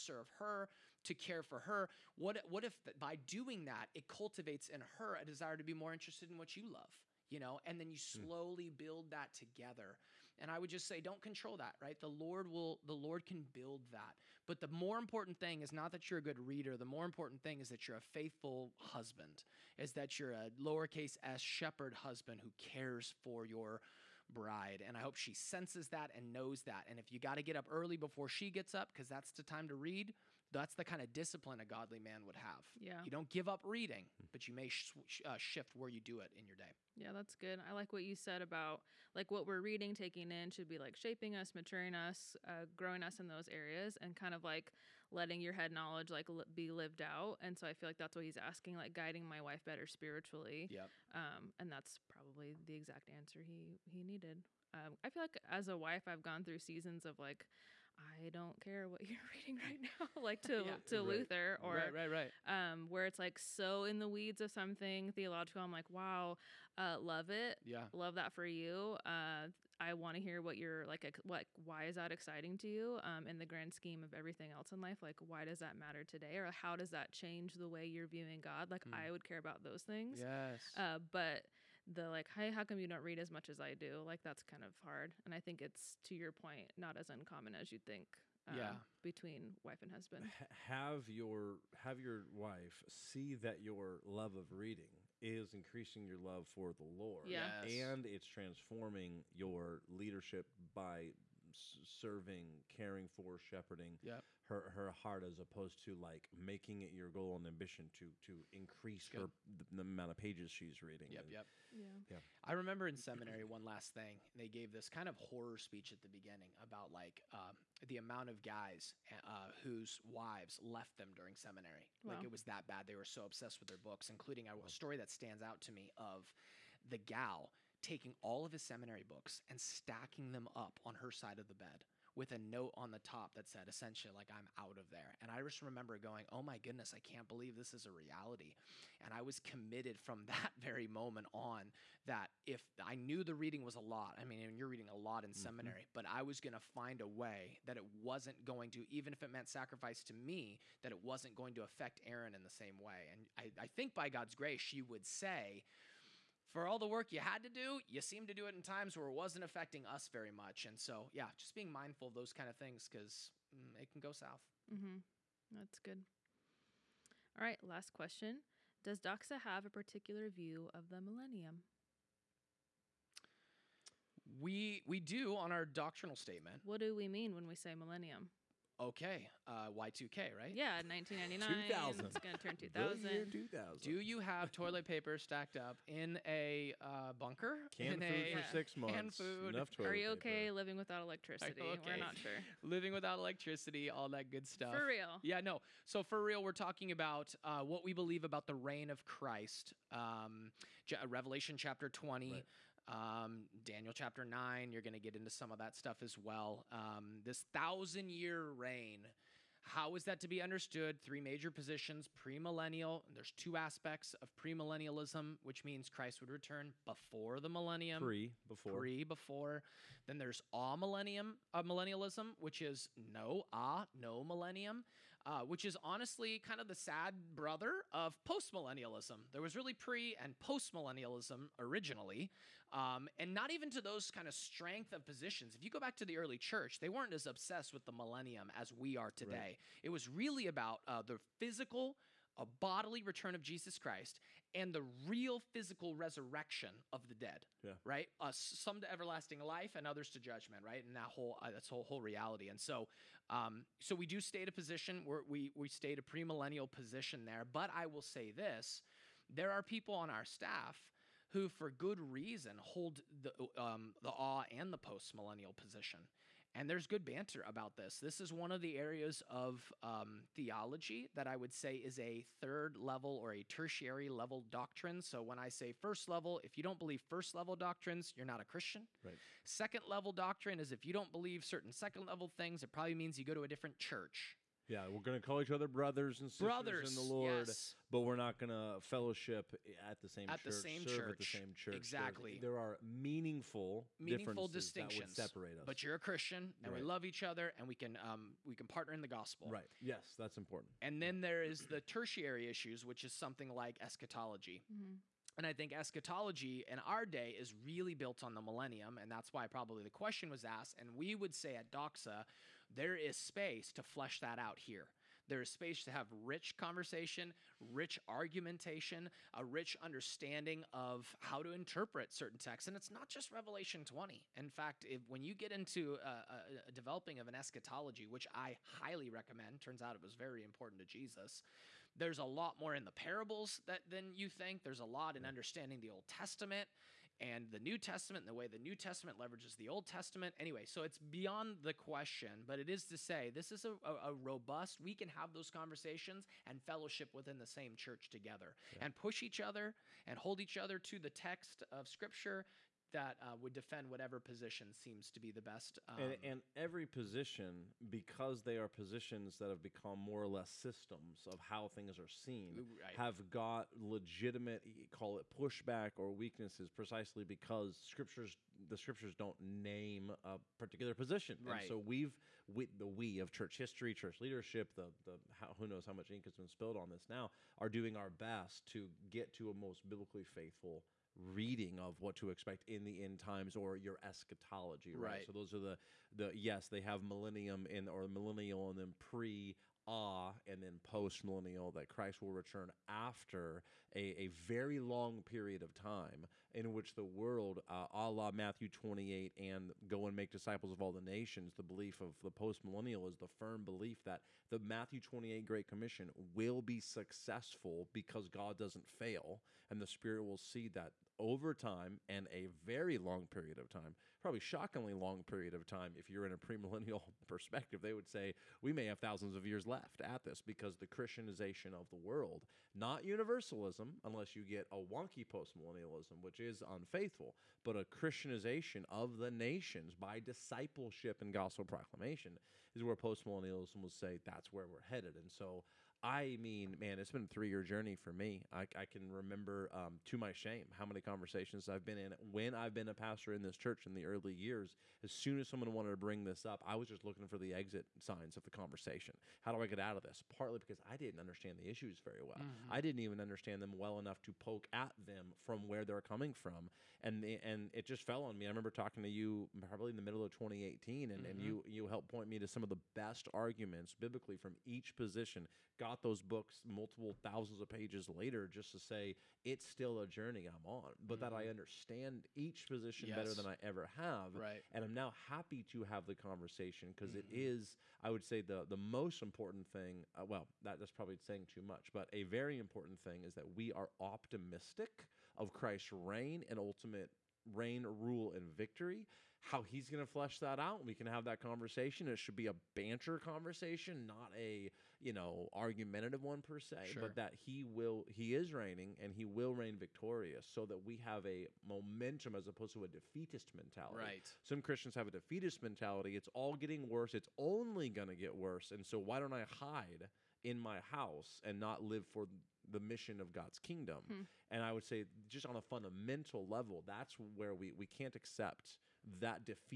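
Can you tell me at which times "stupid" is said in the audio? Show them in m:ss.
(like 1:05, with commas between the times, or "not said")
not said.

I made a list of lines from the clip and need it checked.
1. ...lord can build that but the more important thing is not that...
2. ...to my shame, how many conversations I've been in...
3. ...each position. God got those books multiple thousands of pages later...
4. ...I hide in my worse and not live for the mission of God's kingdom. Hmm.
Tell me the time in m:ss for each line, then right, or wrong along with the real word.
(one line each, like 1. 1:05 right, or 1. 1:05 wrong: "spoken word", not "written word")
1. 0:12 right
2. 7:20 right
3. 7:44 right
4. 8:29 wrong: "house", not "worse".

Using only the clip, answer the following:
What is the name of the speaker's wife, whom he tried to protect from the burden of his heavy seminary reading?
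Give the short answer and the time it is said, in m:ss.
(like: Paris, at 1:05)
Aaron, at 2:32.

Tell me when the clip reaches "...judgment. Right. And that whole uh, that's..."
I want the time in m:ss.
4:10.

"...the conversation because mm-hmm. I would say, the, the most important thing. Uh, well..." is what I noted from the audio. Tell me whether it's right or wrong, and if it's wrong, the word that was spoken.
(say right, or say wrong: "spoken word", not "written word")
right.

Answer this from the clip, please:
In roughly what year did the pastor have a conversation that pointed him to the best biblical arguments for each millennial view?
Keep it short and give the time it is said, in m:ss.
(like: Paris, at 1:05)
2018, at 7:40.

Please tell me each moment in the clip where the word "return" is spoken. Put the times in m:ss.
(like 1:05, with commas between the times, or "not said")
3:36, 4:03, 6:32.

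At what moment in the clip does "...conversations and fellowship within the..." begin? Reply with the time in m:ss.
5:45.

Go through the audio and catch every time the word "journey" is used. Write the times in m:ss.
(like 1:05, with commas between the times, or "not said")
7:17, 7:50.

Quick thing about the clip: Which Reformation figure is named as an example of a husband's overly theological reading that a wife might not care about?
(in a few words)
Luther.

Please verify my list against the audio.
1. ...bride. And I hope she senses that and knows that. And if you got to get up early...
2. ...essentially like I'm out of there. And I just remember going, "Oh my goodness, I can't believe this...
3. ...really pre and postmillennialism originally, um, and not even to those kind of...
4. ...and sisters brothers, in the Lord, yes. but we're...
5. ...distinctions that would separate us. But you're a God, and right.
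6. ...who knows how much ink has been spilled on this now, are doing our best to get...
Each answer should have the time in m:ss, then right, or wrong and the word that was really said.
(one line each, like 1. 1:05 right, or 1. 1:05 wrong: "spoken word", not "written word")
1. 0:24 right
2. 2:13 right
3. 3:49 right
4. 4:46 right
5. 4:54 wrong: "Christian", not "God"
6. 6:15 right.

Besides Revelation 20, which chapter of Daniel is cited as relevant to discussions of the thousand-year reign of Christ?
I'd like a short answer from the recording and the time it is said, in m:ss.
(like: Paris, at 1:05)
Daniel 9, at 3:23.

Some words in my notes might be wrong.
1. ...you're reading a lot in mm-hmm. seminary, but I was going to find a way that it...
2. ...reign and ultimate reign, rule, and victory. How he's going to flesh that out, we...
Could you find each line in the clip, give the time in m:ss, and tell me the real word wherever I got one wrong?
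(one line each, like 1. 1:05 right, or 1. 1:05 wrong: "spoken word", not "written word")
1. 2:24 right
2. 8:05 right.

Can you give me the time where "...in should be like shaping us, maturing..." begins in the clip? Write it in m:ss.
0:40.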